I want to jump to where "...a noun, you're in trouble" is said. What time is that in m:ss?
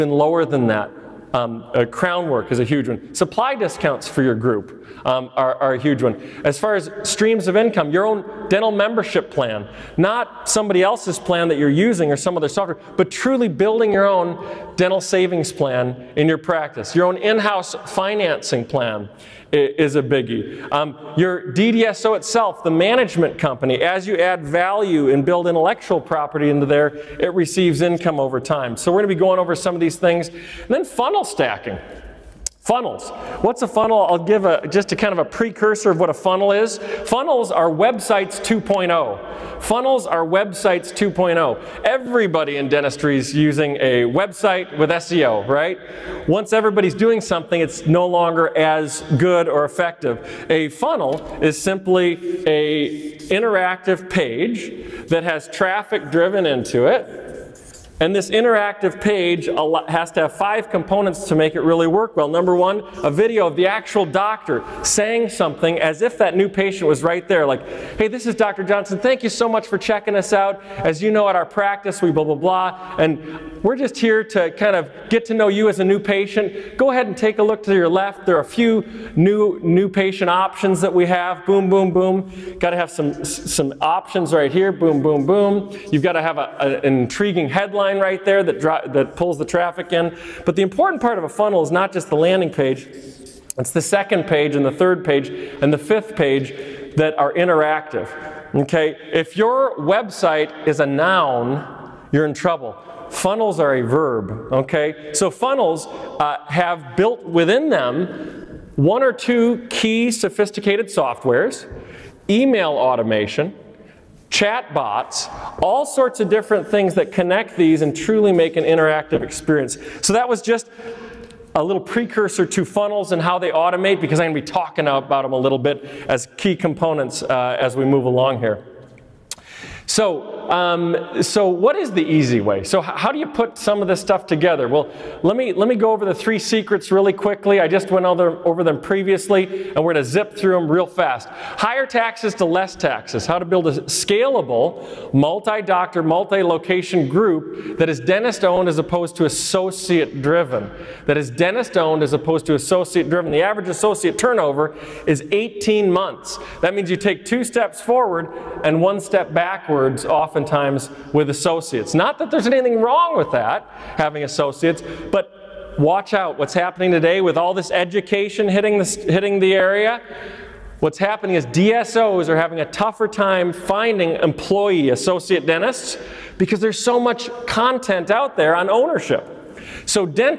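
1:40.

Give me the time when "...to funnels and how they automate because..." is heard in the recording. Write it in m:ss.
2:02.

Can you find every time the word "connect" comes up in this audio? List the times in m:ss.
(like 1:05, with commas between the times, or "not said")
1:57.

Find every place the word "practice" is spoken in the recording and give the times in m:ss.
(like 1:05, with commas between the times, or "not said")
0:16, 1:11.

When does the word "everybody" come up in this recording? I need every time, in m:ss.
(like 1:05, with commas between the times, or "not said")
0:41, 0:46.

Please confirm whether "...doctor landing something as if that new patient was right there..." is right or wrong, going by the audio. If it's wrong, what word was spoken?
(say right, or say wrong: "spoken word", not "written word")
wrong: "saying", not "landing".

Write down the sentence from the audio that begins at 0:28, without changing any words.
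So we're going to be going over some of these things.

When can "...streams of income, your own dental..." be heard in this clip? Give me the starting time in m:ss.
0:07.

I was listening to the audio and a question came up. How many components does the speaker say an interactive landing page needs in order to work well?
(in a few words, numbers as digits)
5.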